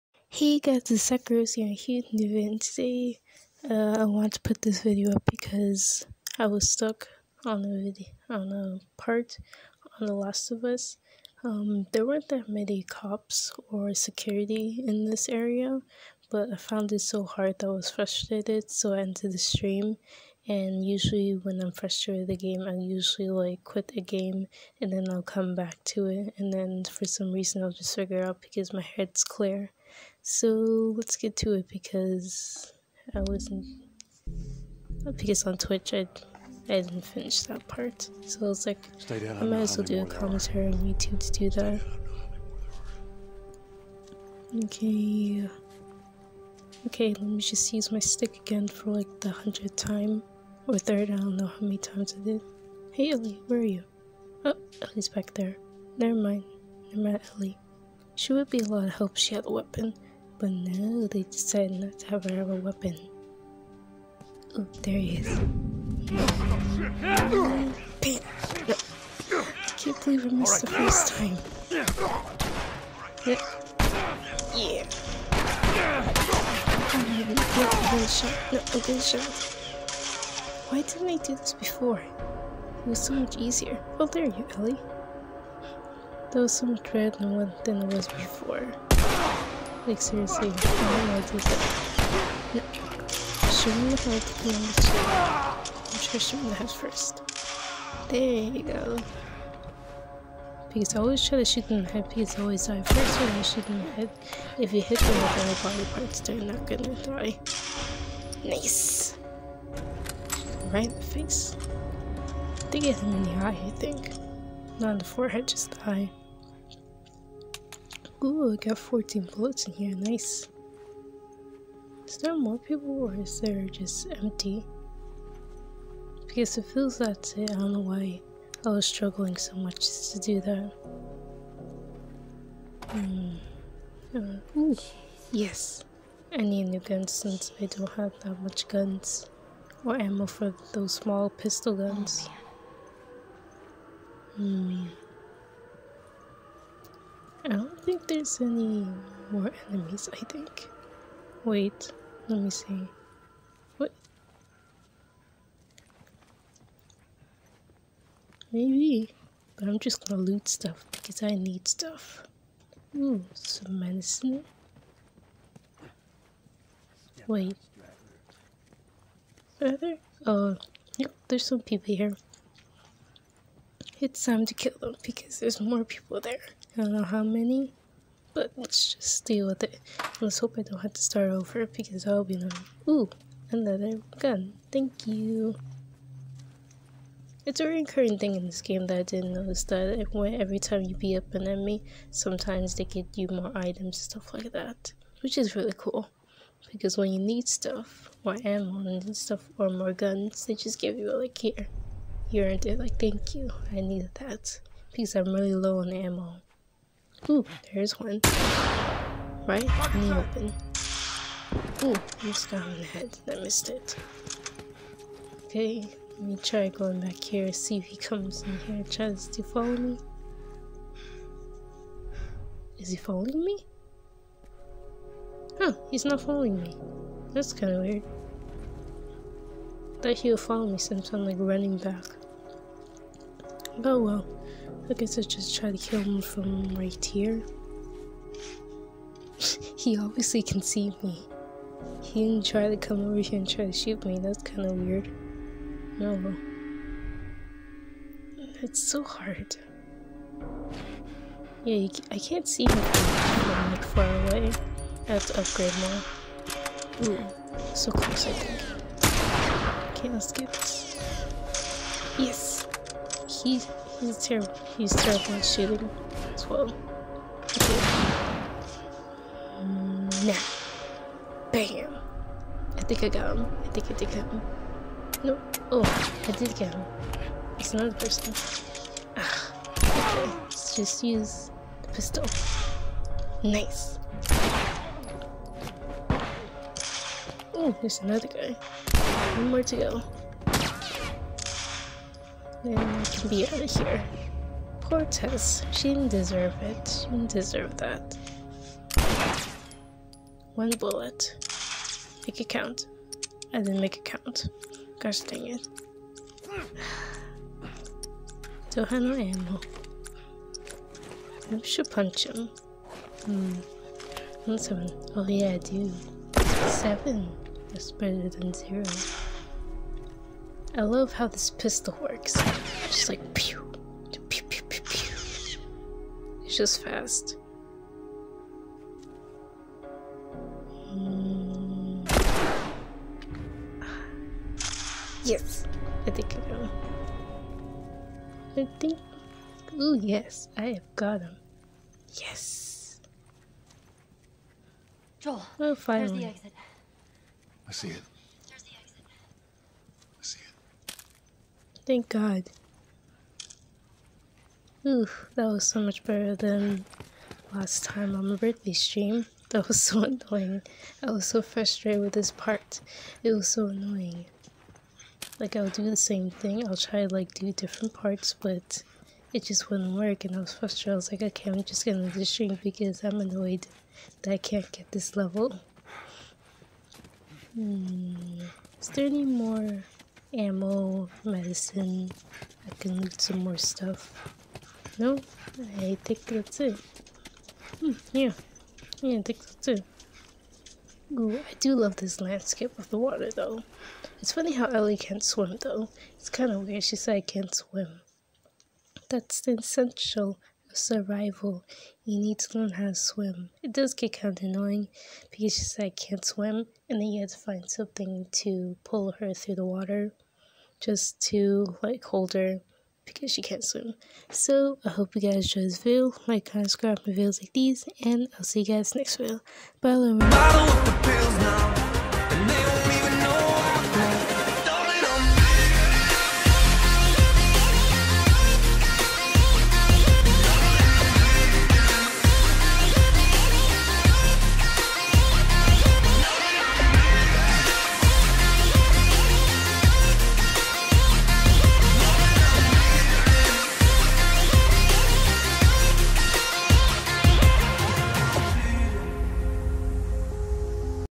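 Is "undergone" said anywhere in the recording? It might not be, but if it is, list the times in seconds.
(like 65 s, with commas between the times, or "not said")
not said.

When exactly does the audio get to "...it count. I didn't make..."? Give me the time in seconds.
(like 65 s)
302 s.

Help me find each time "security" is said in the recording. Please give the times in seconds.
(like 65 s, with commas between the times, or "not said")
13 s.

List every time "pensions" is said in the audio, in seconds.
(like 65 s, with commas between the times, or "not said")
not said.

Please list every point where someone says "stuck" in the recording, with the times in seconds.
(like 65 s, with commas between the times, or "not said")
6 s.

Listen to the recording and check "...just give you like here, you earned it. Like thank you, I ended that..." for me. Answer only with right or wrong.
wrong.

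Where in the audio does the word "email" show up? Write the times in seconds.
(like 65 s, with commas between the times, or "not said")
not said.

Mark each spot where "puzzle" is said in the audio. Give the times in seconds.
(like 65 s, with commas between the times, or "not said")
not said.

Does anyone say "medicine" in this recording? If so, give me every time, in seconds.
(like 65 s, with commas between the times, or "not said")
163 s, 381 s.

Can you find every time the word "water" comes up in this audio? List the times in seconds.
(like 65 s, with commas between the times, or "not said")
392 s, 409 s.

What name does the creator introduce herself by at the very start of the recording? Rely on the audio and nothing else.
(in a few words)
Sakura Rose.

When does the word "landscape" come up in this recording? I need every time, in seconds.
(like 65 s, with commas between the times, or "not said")
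392 s.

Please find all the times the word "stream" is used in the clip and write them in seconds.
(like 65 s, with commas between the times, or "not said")
19 s, 358 s, 372 s.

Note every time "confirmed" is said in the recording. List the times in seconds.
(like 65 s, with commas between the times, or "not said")
not said.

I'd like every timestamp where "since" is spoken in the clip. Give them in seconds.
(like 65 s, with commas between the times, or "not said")
137 s, 230 s.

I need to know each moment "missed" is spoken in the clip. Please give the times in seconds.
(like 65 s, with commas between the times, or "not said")
70 s, 213 s.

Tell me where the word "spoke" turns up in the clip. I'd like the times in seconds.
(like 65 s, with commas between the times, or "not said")
not said.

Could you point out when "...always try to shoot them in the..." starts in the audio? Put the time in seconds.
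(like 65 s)
101 s.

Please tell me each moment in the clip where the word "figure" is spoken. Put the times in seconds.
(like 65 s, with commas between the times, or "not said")
27 s.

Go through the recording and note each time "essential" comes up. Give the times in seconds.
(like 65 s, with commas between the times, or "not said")
399 s.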